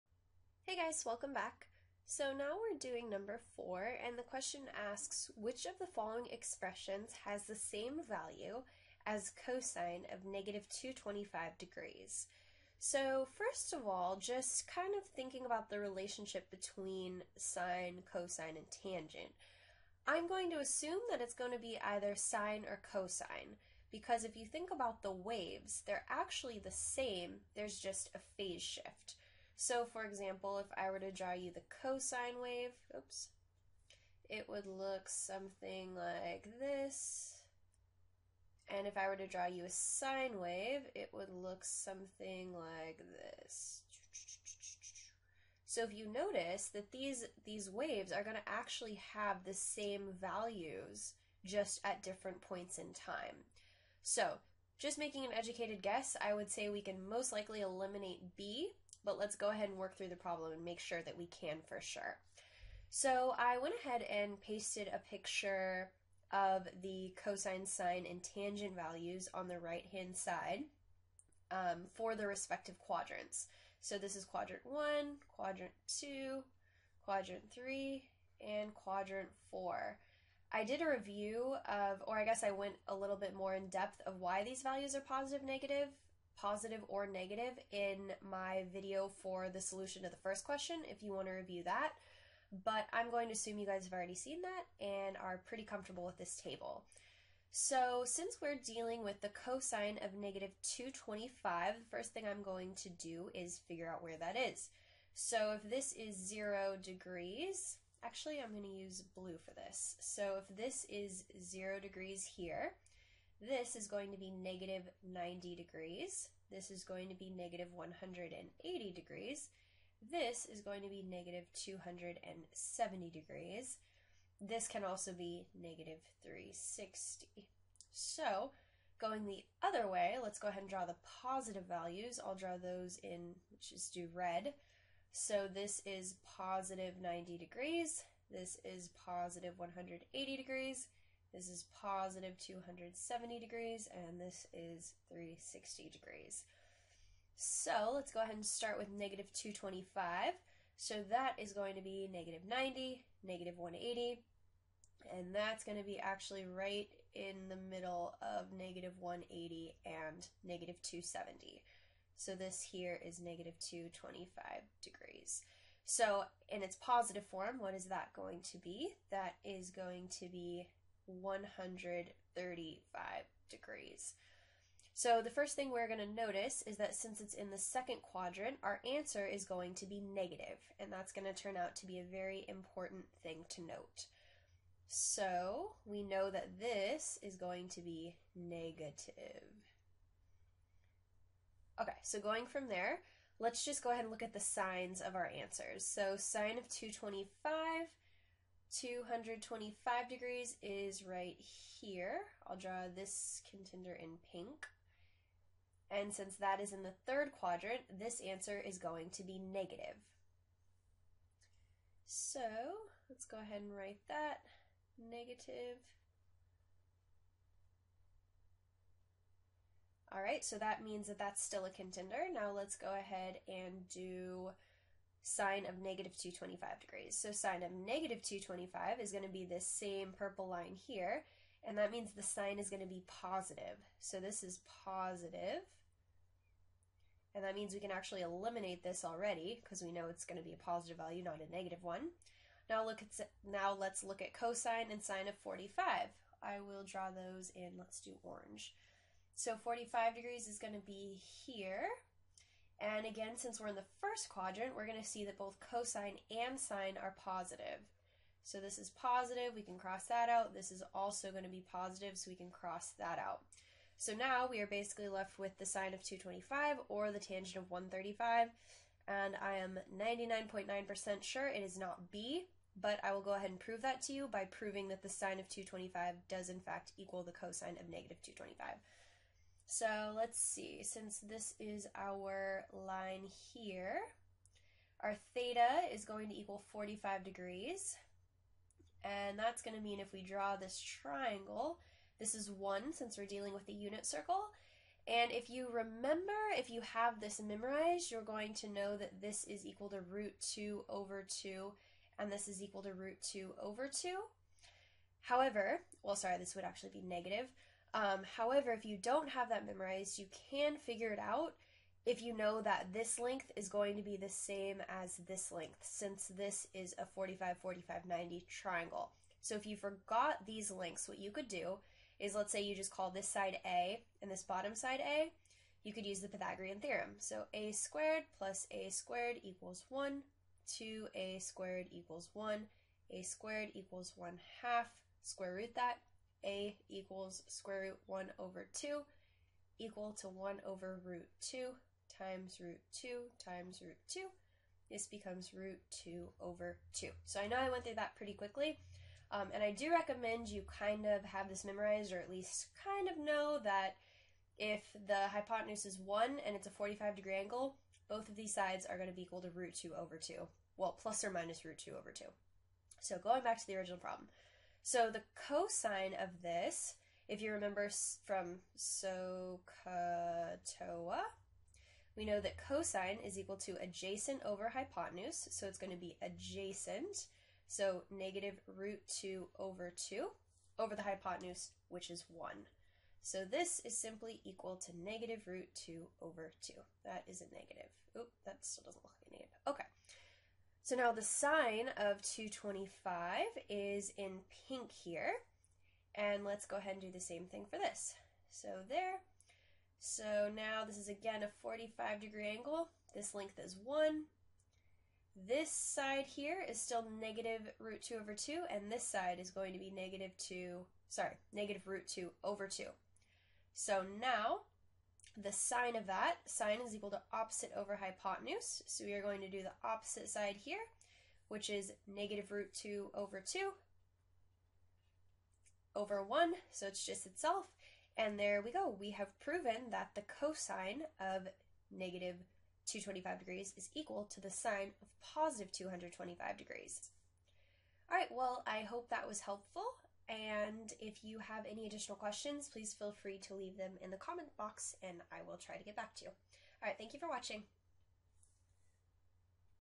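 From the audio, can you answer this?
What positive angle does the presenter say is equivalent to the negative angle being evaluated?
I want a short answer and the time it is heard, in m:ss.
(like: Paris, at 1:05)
135 degrees, at 2:51.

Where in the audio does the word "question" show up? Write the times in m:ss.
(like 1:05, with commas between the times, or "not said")
0:04, 1:30, 7:22.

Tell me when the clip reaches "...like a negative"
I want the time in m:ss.
6:29.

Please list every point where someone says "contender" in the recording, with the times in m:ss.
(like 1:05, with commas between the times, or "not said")
3:23, 3:41.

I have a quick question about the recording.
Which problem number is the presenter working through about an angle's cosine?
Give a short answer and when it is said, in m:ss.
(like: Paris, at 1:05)
4, at 0:03.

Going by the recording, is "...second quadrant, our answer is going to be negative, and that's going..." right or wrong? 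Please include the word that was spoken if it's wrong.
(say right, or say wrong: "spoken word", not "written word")
right.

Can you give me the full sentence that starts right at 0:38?
And if I were to draw you a sine wave, it would look something like this.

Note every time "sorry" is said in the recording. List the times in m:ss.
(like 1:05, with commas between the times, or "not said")
5:06, 6:51.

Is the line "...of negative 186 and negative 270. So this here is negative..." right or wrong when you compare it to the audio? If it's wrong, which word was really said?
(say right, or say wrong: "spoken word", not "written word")
wrong: "180", not "186".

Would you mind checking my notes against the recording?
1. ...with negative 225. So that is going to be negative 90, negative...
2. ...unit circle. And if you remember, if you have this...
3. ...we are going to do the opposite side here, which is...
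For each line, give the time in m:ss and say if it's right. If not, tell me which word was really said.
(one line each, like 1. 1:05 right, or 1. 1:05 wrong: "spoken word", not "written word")
1. 2:28 right
2. 4:53 right
3. 6:59 right.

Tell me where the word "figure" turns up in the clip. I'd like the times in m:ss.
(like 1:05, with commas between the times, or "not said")
1:43, 5:10.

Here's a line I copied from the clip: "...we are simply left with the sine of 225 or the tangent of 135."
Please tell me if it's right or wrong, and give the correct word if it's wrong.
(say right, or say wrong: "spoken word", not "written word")
wrong: "basically", not "simply".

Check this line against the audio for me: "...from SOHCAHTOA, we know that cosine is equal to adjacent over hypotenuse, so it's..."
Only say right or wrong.
right.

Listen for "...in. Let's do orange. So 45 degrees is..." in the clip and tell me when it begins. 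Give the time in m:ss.
4:07.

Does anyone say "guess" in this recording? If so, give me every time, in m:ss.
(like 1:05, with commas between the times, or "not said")
0:55, 1:22.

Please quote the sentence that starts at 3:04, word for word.
So we know that this is going to be negative.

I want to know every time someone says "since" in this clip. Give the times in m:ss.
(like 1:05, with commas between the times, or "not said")
1:38, 2:56, 3:26, 4:13, 4:40, 4:52, 5:15.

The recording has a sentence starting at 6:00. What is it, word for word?
Well, plus or minus root 2 over 2.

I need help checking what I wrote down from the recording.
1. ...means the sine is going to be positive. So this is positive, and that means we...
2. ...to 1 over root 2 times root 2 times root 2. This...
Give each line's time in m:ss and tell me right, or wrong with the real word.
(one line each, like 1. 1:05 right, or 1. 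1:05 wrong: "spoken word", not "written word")
1. 3:51 right
2. 5:40 right.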